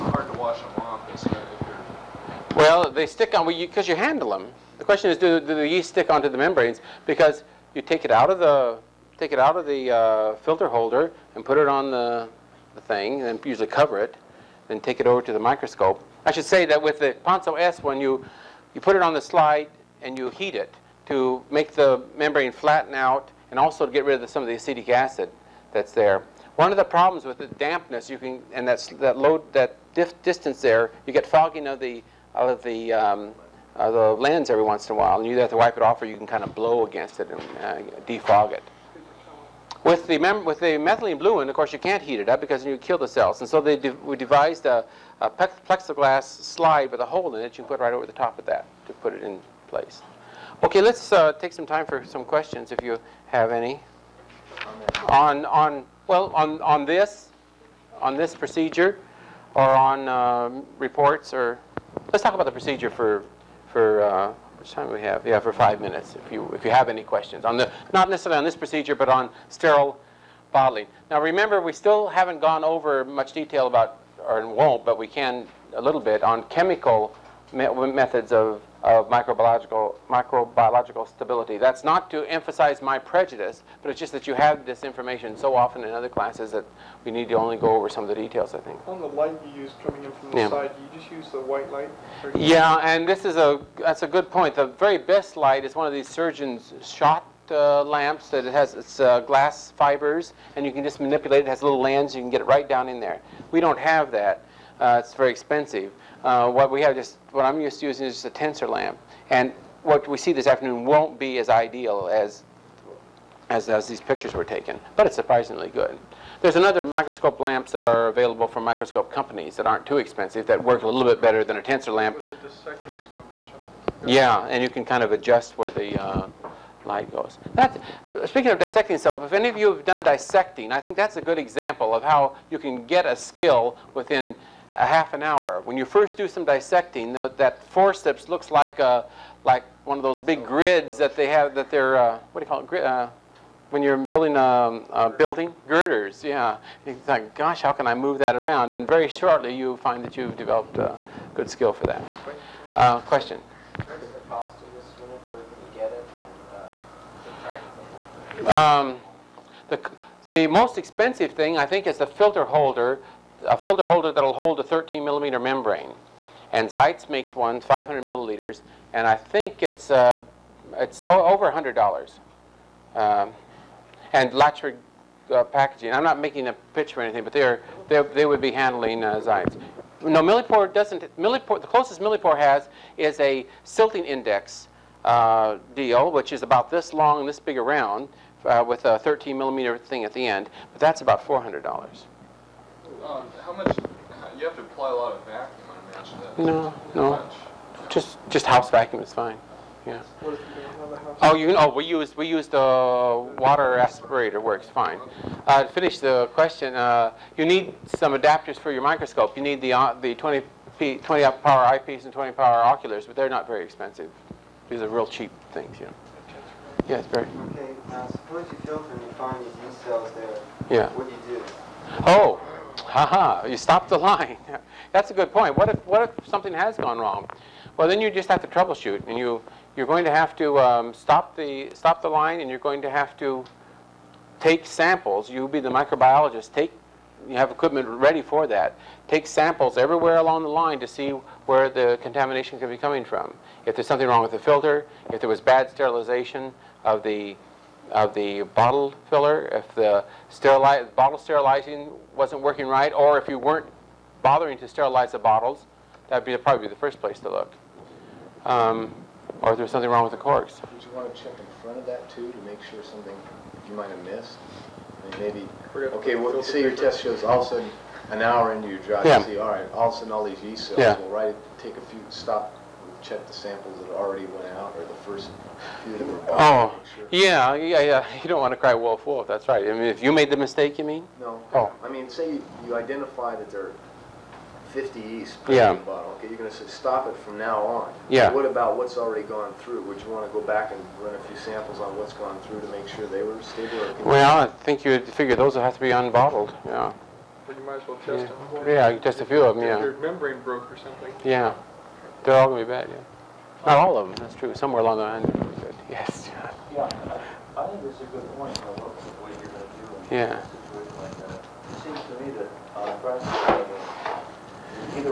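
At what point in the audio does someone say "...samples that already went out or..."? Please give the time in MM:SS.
04:33.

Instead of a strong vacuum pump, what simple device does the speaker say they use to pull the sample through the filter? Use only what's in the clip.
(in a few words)
water aspirator.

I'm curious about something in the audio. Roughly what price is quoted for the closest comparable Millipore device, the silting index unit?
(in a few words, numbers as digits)
$400.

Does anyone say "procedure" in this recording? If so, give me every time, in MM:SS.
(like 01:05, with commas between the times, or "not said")
00:58, 01:02, 01:08.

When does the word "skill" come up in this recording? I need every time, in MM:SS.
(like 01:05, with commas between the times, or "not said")
02:13, 02:31.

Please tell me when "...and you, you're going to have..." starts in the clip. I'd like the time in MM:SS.
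03:49.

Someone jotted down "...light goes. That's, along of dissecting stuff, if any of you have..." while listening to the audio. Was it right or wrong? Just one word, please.
wrong.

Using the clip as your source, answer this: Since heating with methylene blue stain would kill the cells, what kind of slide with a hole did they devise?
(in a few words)
plexiglass slide.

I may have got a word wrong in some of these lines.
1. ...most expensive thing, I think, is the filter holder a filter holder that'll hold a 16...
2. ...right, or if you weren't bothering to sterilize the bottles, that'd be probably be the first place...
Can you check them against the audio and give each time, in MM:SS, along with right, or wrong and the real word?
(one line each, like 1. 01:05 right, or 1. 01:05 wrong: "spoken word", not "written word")
1. 02:40 wrong: "13", not "16"
2. 04:12 right.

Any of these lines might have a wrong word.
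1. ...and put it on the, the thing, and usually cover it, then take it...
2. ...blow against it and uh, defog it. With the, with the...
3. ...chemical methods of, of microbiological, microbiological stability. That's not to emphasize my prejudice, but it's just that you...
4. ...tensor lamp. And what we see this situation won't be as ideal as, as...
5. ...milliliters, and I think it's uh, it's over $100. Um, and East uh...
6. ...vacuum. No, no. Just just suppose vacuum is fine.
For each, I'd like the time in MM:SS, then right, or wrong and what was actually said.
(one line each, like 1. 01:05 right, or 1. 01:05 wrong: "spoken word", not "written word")
1. 00:11 right
2. 00:36 right
3. 01:16 right
4. 01:48 wrong: "afternoon", not "situation"
5. 02:48 wrong: "Latchford", not "East"
6. 03:15 wrong: "house", not "suppose".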